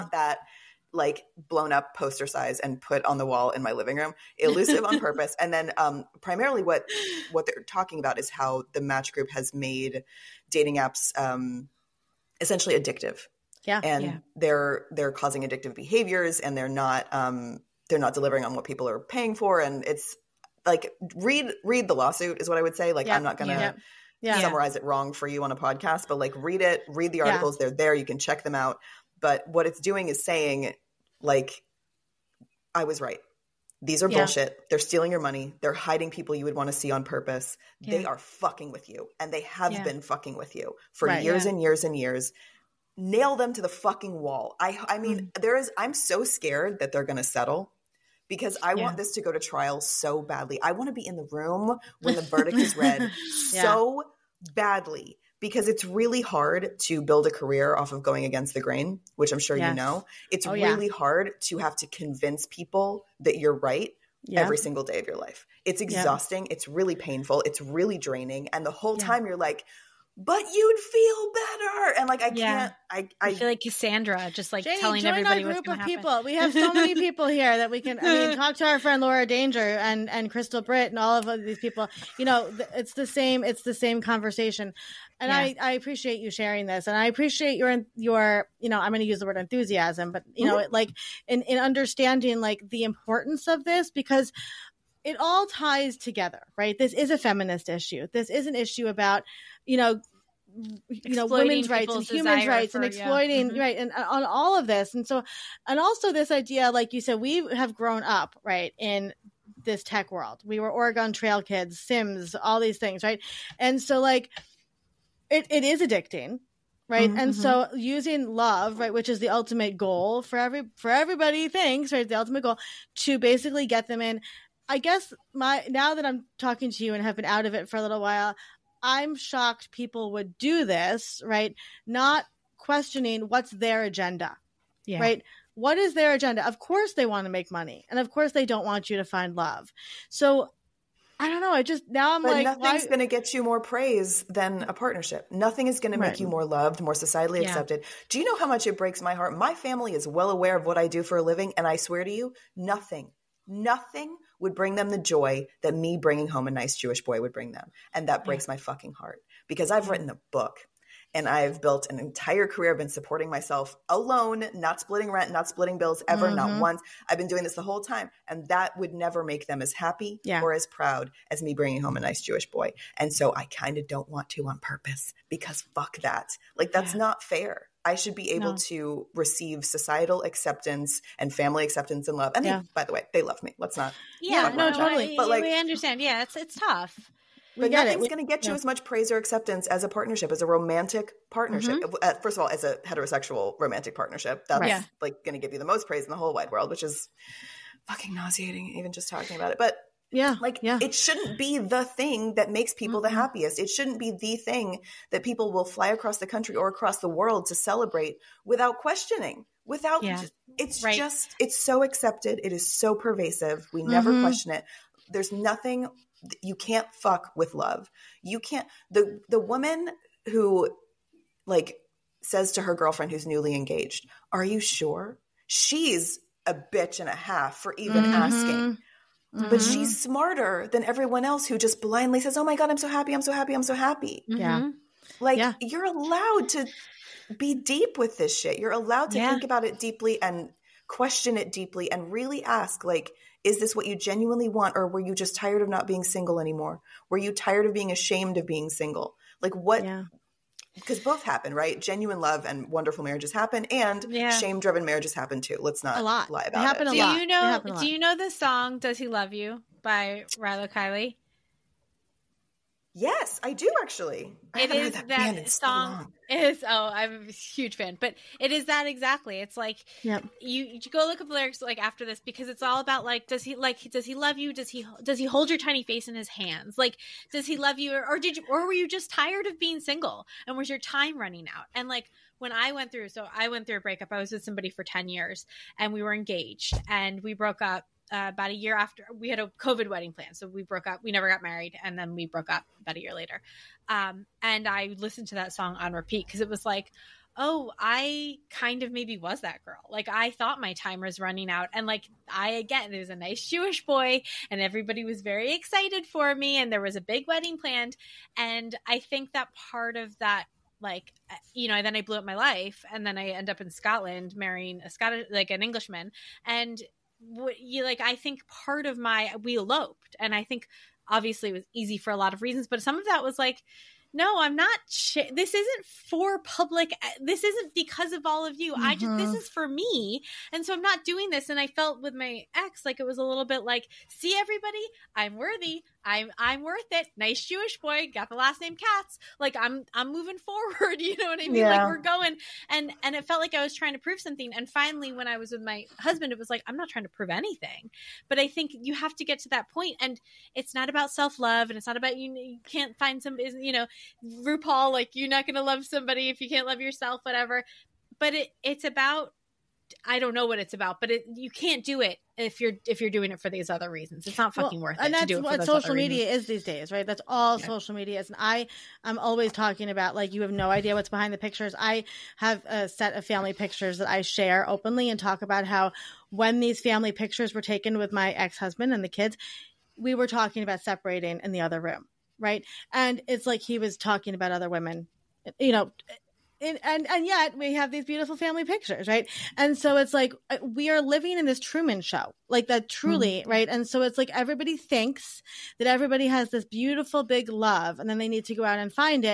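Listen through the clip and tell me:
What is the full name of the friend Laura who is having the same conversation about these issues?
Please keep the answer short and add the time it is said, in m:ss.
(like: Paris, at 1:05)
Laura Danger, at 1:19.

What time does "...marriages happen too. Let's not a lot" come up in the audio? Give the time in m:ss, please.
4:14.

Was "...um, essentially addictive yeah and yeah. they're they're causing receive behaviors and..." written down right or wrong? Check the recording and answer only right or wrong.
wrong.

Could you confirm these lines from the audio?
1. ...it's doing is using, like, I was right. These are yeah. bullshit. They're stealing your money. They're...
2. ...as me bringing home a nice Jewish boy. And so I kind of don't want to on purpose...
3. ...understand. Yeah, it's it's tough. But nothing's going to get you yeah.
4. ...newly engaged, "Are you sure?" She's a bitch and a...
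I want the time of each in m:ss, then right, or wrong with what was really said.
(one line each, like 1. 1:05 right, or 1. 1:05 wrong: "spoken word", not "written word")
1. 0:29 wrong: "saying", not "using"
2. 2:51 right
3. 3:05 right
4. 3:43 right.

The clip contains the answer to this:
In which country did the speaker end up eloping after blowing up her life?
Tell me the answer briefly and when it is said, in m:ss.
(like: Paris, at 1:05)
Scotland, at 5:13.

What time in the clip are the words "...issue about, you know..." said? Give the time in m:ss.
1:38.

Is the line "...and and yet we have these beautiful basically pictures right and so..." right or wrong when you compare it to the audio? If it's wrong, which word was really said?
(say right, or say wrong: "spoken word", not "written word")
wrong: "family", not "basically".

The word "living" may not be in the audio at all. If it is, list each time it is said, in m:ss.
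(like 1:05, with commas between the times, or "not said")
0:03, 2:31, 6:31.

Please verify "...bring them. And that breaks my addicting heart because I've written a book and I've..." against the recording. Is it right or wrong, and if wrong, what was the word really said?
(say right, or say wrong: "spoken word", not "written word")
wrong: "fucking", not "addicting".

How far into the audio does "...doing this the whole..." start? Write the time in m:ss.
2:47.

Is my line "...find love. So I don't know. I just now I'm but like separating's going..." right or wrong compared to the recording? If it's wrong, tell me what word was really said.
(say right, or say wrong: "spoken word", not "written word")
wrong: "nothing", not "separating".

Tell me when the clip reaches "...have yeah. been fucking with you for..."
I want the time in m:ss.
0:39.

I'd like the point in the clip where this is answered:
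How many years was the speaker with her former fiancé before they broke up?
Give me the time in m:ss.
4:44.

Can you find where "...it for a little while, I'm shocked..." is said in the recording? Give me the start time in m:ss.
2:07.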